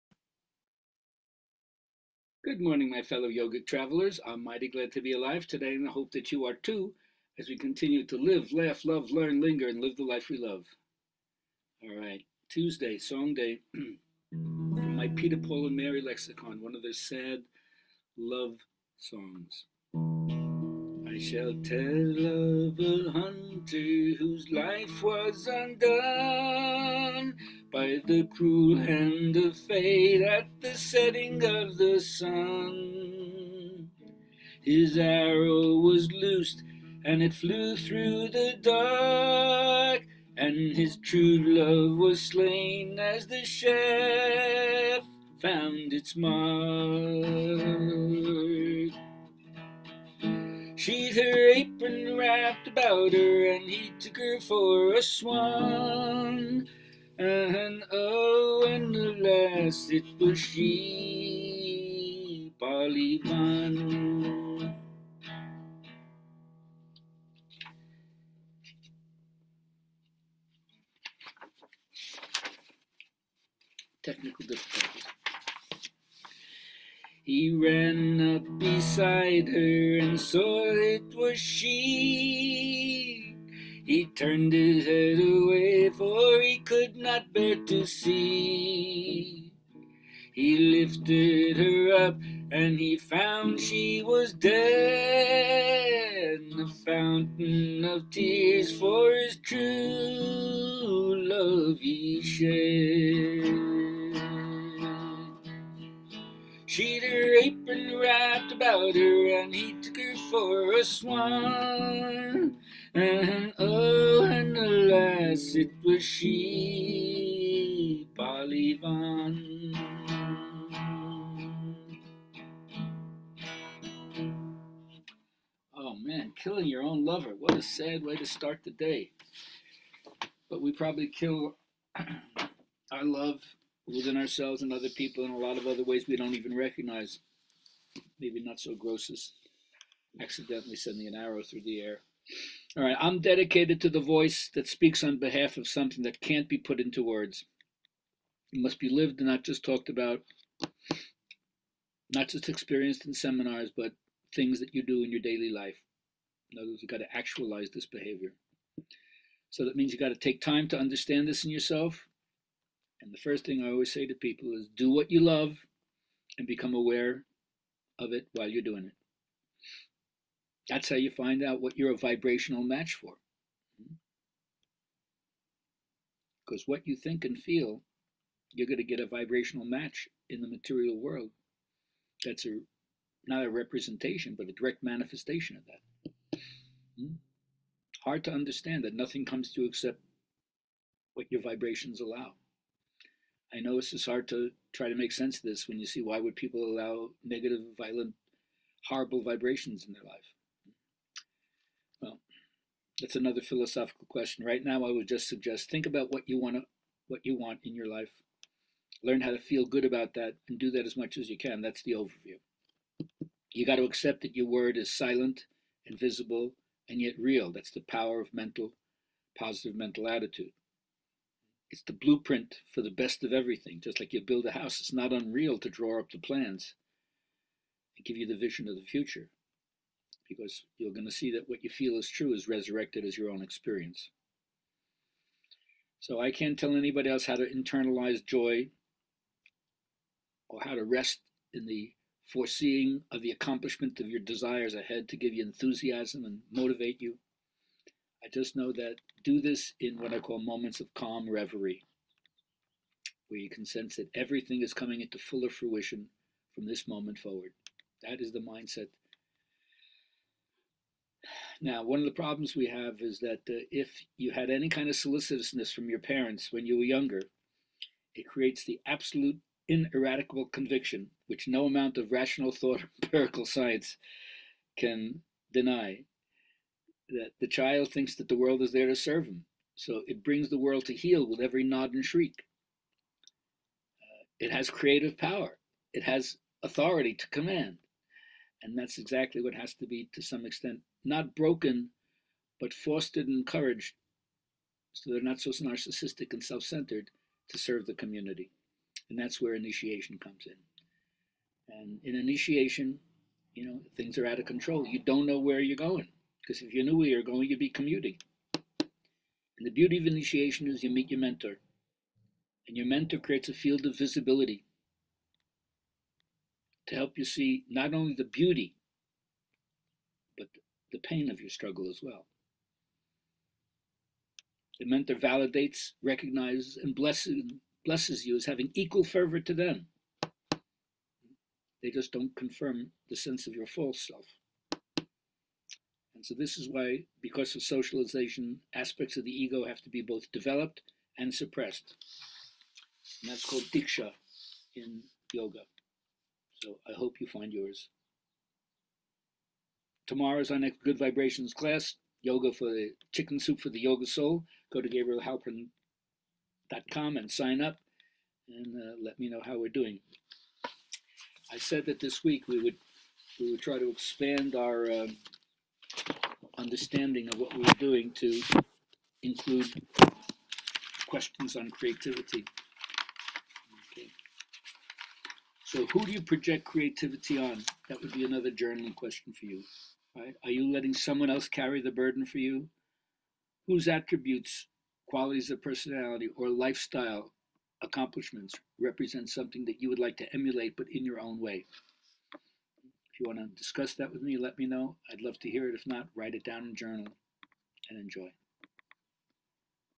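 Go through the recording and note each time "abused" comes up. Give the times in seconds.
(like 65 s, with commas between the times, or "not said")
not said.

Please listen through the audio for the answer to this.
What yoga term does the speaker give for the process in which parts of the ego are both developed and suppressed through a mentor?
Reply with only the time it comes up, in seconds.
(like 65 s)
343 s.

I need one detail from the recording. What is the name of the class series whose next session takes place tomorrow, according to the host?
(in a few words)
Good Vibrations.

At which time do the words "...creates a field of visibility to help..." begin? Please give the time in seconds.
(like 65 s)
313 s.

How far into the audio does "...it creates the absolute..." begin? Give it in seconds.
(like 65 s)
268 s.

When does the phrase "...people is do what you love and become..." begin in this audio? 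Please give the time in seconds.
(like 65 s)
164 s.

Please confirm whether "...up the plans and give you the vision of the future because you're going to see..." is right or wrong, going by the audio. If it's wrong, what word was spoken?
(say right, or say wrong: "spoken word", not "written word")
right.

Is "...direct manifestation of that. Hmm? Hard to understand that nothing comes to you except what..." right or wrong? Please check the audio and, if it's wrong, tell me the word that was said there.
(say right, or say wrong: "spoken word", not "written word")
right.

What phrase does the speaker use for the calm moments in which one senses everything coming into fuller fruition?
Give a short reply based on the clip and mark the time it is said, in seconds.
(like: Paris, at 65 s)
calm reverie, at 250 s.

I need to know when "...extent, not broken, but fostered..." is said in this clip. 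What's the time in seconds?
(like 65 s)
290 s.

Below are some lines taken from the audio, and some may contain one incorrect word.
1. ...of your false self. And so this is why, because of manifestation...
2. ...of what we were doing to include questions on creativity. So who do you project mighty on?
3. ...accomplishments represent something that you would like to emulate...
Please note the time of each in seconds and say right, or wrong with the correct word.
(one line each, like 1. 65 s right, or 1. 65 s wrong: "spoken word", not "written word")
1. 333 s wrong: "socialization", not "manifestation"
2. 367 s wrong: "creativity", not "mighty"
3. 387 s right.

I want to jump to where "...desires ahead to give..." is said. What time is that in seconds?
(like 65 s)
244 s.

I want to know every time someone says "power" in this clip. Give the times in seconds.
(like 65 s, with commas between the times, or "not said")
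217 s, 285 s.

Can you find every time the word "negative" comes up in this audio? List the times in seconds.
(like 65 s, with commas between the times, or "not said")
197 s.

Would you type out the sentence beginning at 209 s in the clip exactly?
Learn how to feel good about that and do that as much as you can.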